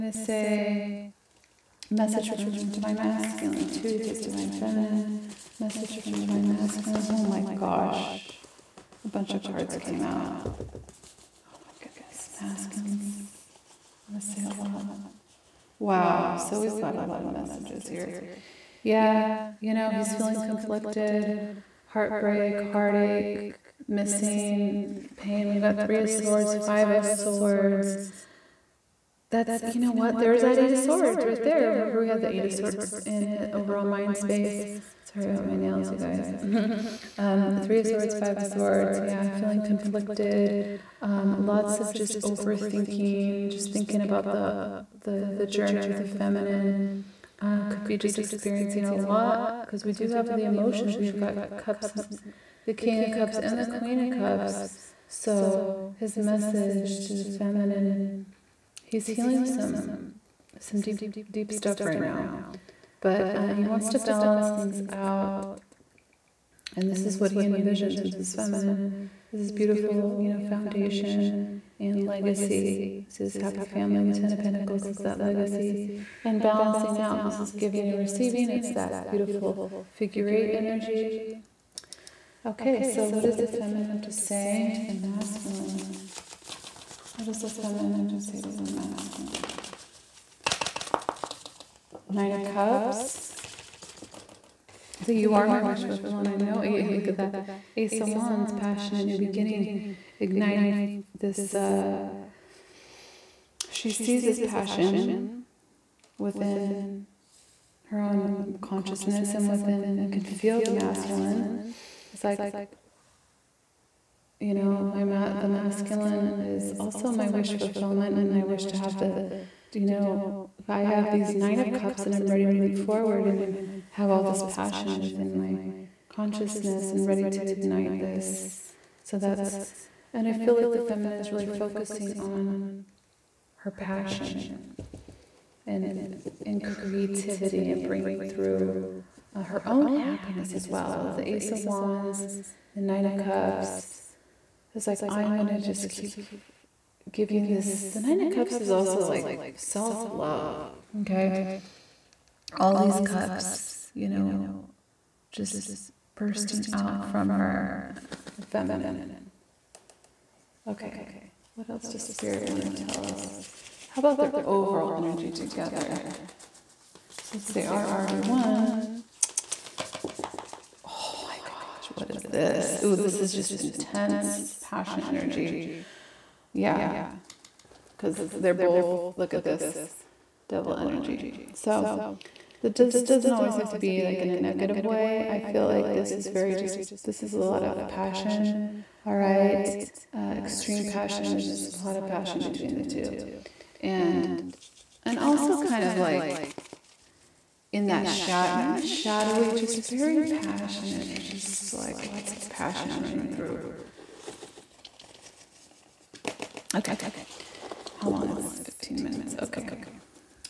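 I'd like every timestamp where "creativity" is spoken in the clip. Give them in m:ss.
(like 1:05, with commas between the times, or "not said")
2:16.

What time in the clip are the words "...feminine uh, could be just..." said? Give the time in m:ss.
0:46.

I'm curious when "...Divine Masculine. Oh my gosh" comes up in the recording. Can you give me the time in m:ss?
0:06.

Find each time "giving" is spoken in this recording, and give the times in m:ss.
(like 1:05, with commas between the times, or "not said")
1:17, 2:27.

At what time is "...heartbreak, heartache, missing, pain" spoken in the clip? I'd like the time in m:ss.
0:21.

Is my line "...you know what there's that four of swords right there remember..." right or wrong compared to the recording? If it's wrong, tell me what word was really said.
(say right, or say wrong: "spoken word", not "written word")
wrong: "eight", not "four".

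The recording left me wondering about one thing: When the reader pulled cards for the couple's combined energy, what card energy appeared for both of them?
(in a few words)
Devil.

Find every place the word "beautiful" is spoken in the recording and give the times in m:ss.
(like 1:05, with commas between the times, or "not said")
1:09, 1:19.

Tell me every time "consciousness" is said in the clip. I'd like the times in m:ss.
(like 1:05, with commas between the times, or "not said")
1:48, 2:06.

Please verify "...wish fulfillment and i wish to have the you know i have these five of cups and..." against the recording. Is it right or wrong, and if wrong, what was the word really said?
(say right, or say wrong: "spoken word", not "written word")
wrong: "nine", not "five".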